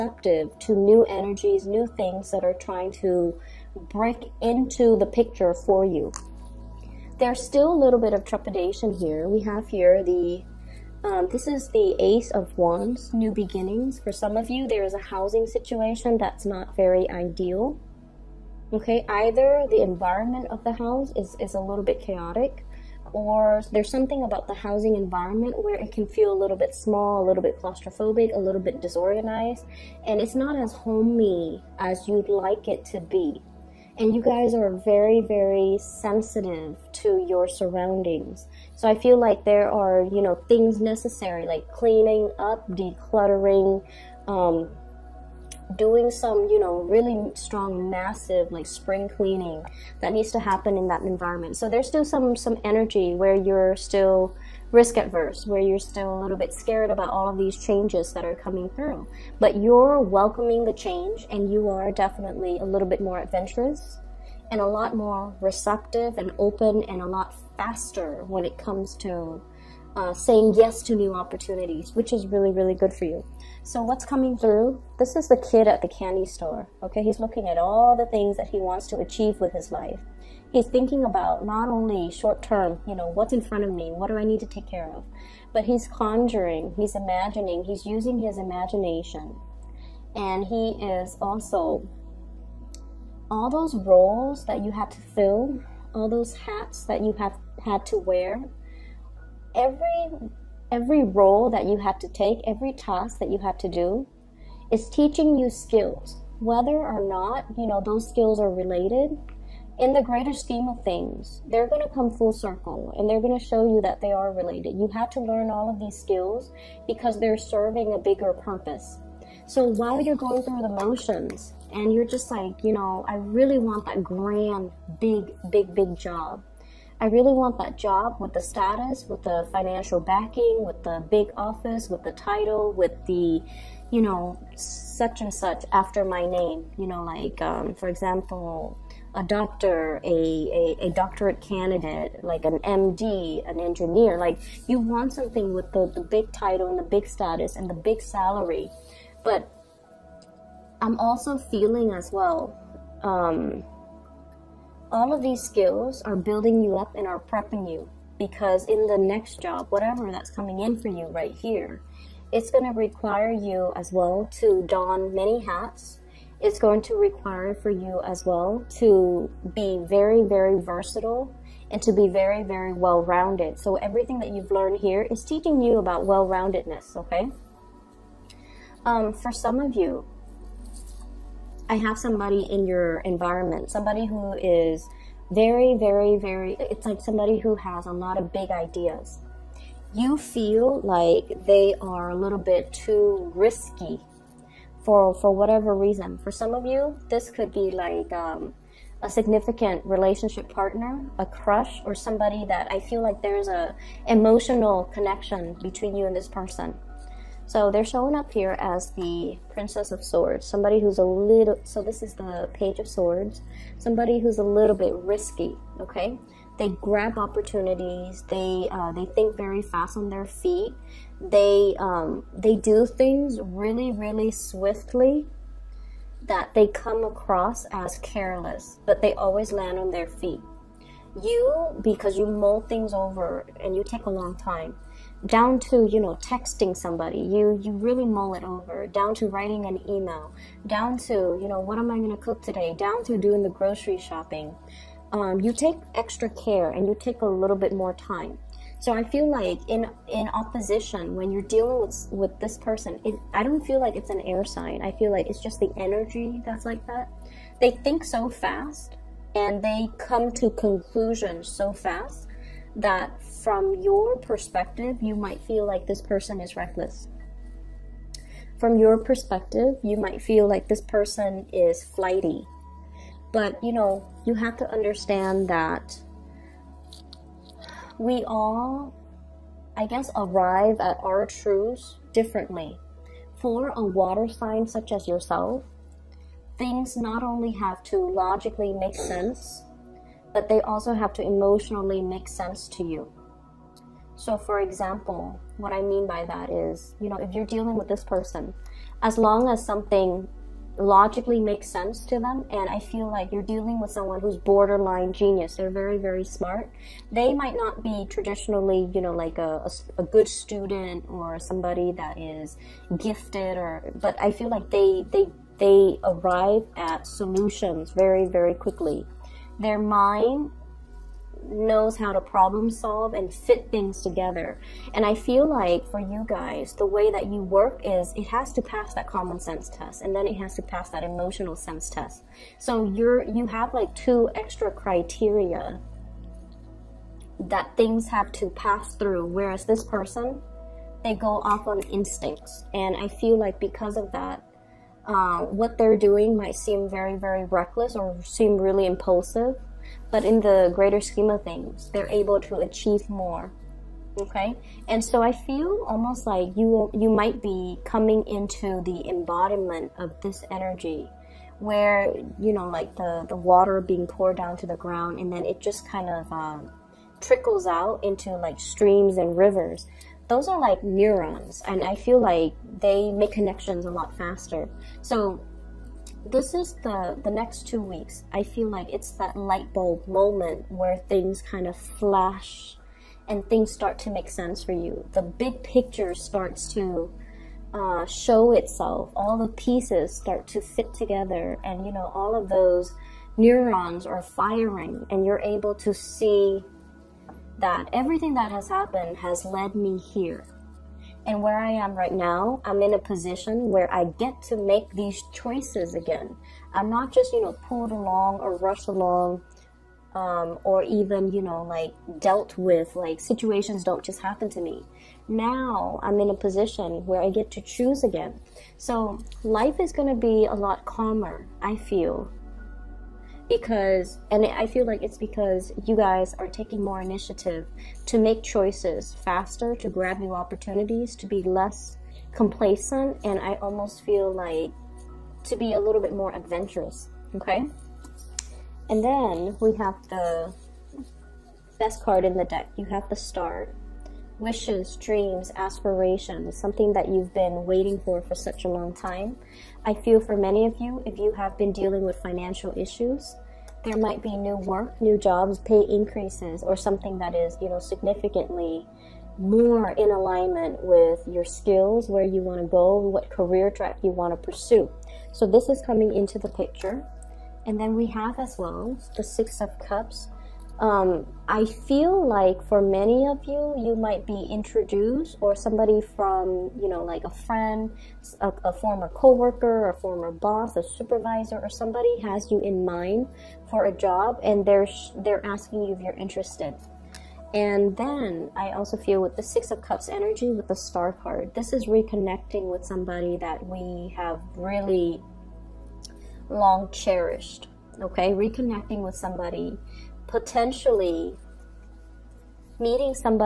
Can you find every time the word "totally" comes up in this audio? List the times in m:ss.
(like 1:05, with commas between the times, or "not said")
not said.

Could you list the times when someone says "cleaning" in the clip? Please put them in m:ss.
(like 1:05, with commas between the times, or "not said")
0:41, 0:49.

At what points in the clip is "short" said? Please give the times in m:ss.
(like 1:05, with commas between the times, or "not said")
1:22.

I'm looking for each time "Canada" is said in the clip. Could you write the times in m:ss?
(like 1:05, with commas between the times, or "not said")
not said.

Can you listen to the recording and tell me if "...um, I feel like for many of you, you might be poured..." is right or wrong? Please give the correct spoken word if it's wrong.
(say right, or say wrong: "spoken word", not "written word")
wrong: "introduced", not "poured".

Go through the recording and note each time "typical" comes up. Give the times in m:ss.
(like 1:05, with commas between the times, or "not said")
not said.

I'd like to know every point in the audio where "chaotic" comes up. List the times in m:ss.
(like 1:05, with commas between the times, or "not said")
0:21.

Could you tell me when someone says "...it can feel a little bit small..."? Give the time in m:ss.
0:25.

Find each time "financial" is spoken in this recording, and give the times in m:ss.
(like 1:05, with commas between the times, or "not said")
2:09, 7:32.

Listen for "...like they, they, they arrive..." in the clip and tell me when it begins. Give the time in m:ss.
5:14.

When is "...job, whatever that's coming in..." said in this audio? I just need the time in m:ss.
2:39.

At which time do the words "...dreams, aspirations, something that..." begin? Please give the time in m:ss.
7:24.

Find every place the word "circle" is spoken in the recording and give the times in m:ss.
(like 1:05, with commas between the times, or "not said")
1:52.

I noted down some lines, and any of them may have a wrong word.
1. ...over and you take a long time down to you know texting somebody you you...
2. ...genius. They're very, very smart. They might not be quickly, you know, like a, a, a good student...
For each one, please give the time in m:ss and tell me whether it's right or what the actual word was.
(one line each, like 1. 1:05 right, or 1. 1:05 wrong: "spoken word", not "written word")
1. 3:52 right
2. 5:05 wrong: "traditionally", not "quickly".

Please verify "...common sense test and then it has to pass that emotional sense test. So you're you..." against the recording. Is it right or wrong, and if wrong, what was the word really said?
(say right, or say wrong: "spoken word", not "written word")
right.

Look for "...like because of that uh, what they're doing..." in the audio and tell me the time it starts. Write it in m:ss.
5:43.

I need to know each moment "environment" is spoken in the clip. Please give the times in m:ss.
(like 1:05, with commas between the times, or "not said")
0:19, 0:24, 0:51, 3:02.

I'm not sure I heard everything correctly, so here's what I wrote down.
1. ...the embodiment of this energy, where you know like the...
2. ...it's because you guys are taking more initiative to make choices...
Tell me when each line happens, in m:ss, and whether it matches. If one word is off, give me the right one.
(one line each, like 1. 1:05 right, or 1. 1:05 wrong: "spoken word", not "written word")
1. 5:58 right
2. 7:05 right.